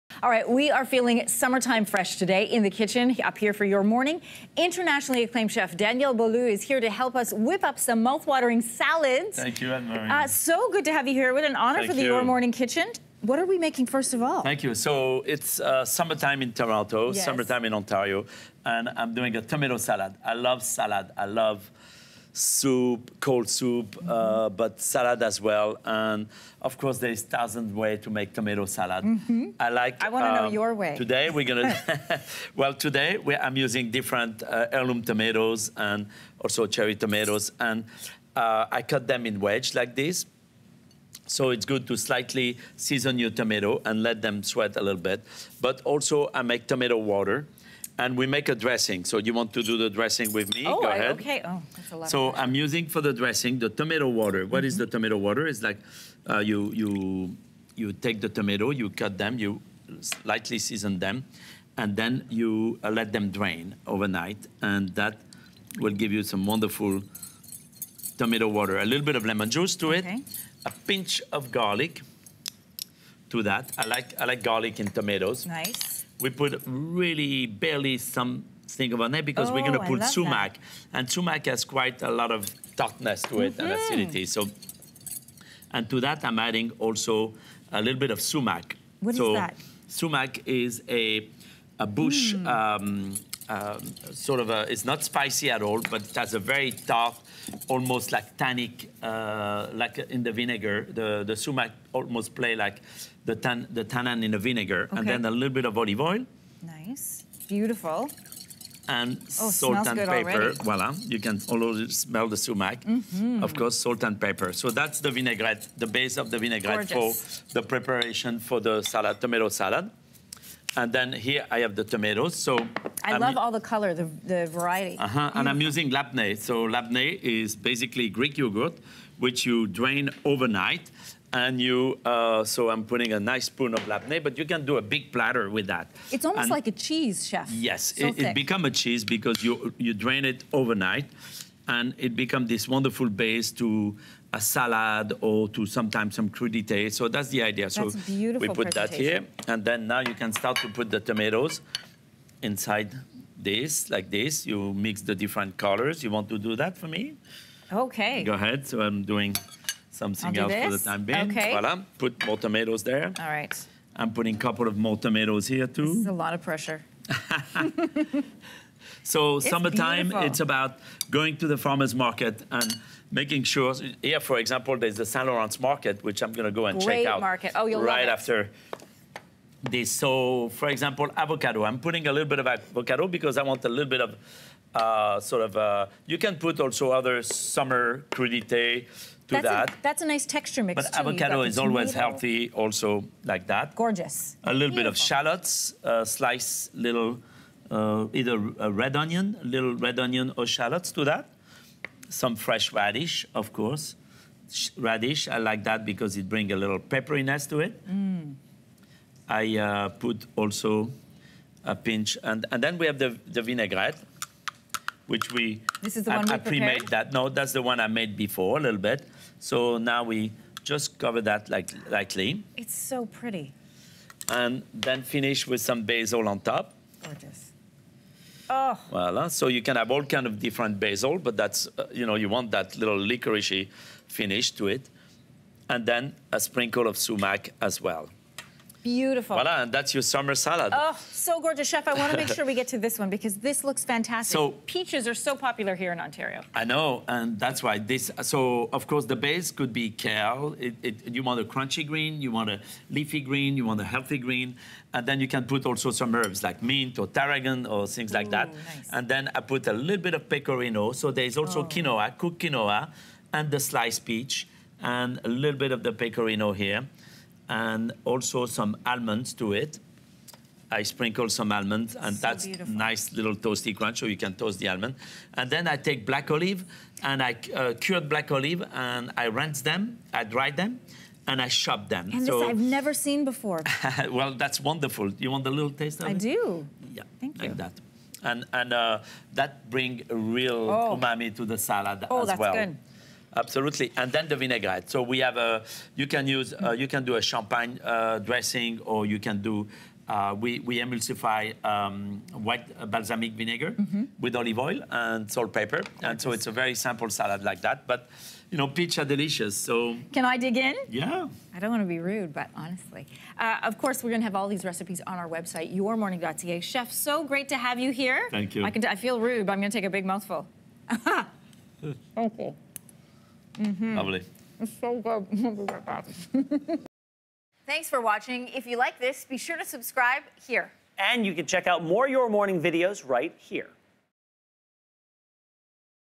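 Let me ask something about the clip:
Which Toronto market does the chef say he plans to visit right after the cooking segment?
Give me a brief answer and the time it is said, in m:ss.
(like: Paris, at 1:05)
Saint Lawrence market, at 2:55.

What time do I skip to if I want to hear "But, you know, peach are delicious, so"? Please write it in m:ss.
5:07.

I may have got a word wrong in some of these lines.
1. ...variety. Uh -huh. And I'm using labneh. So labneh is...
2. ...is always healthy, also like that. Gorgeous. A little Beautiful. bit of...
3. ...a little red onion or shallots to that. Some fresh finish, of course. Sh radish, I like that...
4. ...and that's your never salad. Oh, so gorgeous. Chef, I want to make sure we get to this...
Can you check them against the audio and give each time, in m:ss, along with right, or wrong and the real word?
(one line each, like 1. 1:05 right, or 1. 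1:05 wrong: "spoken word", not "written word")
1. 2:04 right
2. 3:11 right
3. 3:19 wrong: "radish", not "finish"
4. 3:59 wrong: "summer", not "never".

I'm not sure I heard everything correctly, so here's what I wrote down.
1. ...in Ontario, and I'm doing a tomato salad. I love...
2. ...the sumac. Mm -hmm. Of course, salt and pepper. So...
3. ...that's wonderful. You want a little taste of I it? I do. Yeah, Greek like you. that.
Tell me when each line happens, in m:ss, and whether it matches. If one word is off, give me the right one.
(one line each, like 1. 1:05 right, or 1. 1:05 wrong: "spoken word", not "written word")
1. 0:17 right
2. 1:52 right
3. 4:44 wrong: "Thank", not "Greek".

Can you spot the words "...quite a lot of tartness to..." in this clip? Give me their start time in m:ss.
1:21.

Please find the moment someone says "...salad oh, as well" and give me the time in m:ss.
4:51.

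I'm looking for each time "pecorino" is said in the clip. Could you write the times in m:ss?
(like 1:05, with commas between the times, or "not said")
4:20, 4:25.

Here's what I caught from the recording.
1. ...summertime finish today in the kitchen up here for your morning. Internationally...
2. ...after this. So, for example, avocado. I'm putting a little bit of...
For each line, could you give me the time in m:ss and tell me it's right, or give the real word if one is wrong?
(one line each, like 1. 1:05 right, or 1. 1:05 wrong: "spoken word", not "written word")
1. 0:01 wrong: "fresh", not "finish"
2. 2:58 right.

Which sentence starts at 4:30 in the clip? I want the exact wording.
I sprinkle some almonds, and so that's beautiful.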